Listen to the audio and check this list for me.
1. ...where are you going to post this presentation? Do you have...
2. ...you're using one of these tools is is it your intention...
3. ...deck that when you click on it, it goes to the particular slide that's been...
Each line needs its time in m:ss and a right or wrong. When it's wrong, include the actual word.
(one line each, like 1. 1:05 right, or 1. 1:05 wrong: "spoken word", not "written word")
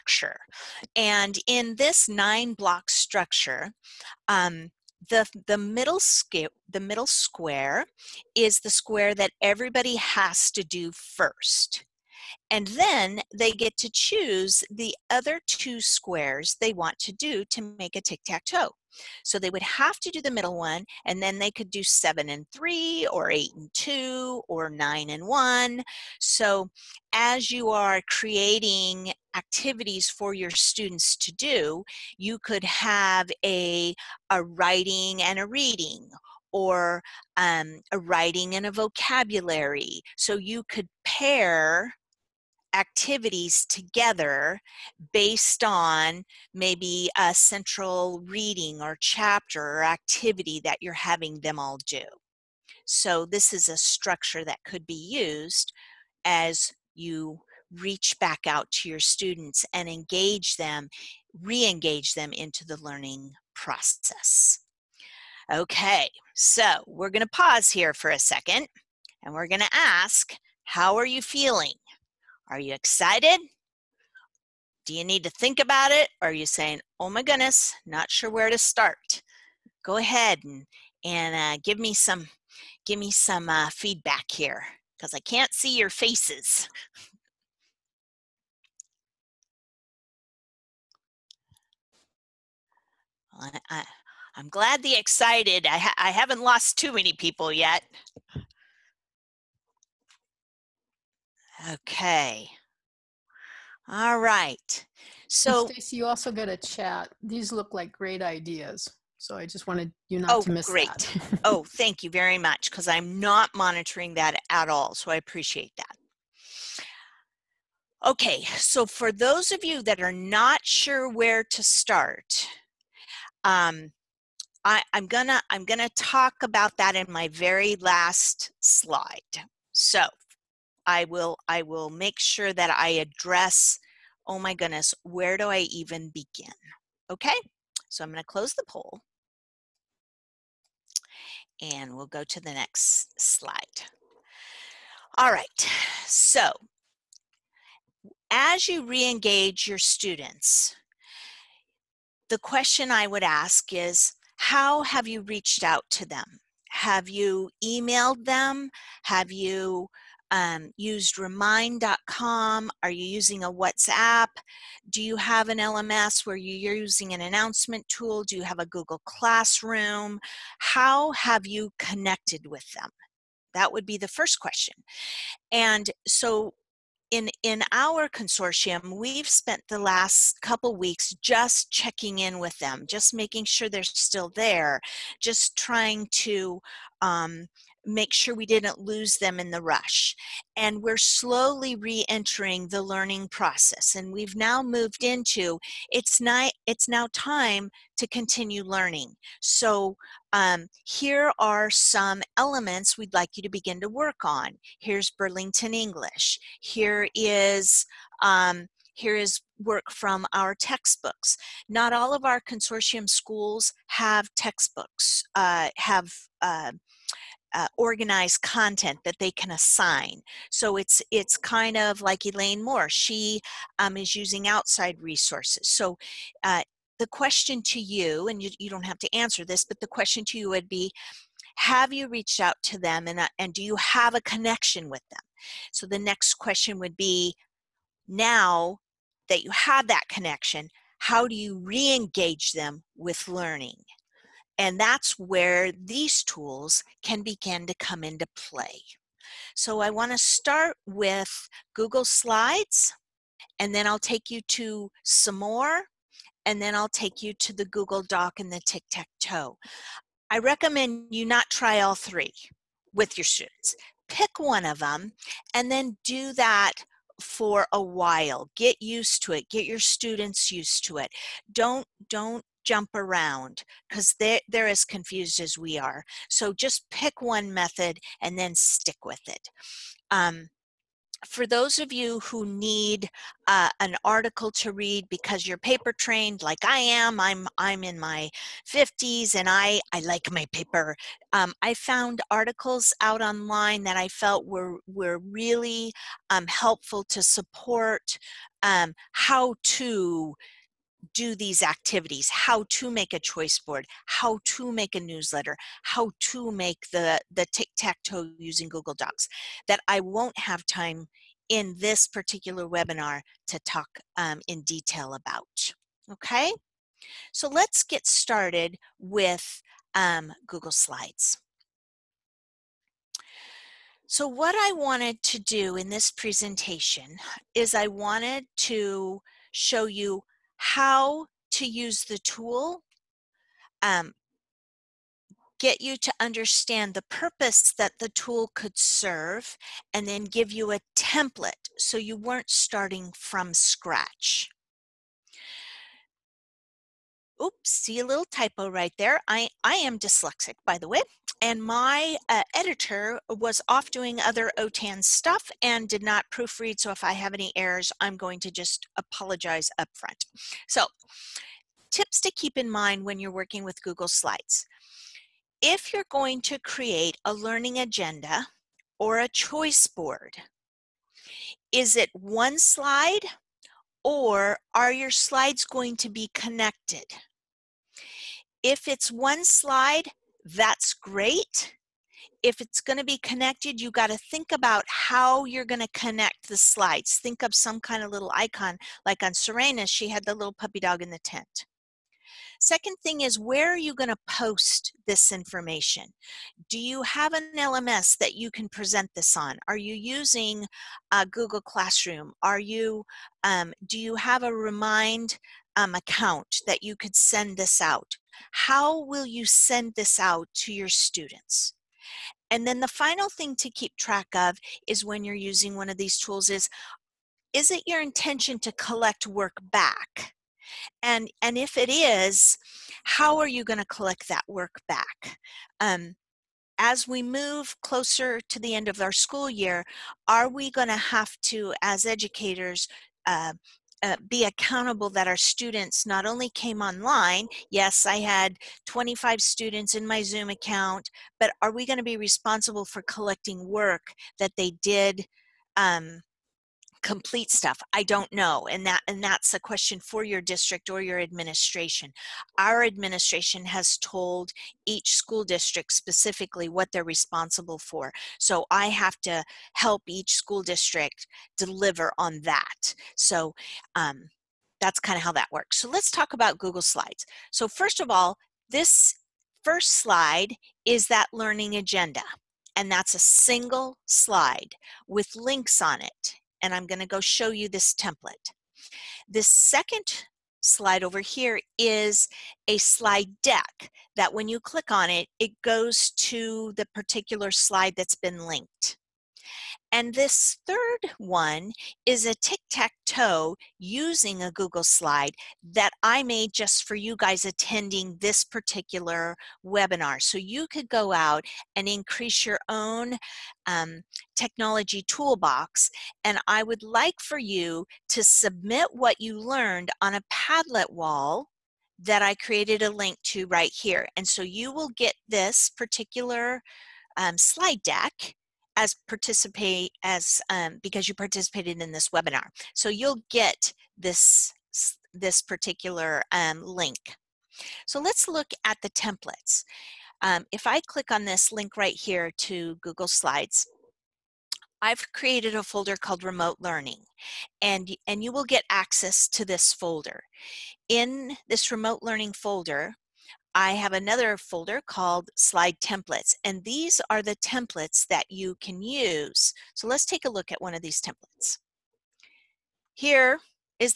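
1. 6:33 wrong: "information", not "presentation"
2. 6:55 right
3. 8:03 right.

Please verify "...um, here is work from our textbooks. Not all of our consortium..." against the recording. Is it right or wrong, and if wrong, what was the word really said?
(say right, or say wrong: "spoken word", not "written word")
right.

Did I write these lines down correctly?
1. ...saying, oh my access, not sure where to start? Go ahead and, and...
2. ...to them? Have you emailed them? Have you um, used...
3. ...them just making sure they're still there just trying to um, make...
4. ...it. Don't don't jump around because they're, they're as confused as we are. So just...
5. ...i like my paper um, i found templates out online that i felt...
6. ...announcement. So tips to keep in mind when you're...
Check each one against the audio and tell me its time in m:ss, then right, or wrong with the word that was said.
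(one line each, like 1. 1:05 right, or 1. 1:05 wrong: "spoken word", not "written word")
1. 1:16 wrong: "goodness", not "access"
2. 2:35 right
3. 3:02 right
4. 4:30 right
5. 4:49 wrong: "articles", not "templates"
6. 5:59 wrong: "front", not "announcement".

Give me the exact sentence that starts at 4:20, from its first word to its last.
I recommend you not try all three with your students.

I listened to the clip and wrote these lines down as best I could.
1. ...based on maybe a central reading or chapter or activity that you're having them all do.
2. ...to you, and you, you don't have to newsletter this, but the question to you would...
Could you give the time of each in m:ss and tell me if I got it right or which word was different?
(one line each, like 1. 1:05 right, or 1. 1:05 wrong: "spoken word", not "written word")
1. 0:45 right
2. 3:47 wrong: "answer", not "newsletter".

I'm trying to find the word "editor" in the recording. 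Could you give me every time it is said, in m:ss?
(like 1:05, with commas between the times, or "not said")
5:52.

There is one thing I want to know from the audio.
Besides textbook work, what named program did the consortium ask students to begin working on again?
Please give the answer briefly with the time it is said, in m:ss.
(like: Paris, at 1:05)
Burlington English, at 3:25.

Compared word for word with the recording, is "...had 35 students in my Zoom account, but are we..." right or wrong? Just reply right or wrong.
wrong.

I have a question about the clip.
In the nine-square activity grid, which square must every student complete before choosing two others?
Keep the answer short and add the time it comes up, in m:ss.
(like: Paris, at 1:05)
The middle square, at 0:06.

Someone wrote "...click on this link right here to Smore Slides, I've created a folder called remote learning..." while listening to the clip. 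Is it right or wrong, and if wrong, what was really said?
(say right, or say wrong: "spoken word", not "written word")
wrong: "Google", not "Smore".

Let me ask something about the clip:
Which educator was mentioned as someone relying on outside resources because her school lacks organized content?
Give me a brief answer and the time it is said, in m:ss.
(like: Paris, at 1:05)
Elaine Moore, at 3:42.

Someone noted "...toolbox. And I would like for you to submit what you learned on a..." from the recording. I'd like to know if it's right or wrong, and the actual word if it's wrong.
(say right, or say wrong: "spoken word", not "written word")
right.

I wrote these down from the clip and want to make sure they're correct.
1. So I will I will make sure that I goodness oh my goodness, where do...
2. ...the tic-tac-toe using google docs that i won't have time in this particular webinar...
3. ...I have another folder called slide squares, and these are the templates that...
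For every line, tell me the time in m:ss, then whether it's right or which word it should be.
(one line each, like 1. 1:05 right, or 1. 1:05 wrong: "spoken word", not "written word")
1. 2:09 wrong: "address", not "goodness"
2. 5:07 right
3. 9:03 wrong: "templates", not "squares".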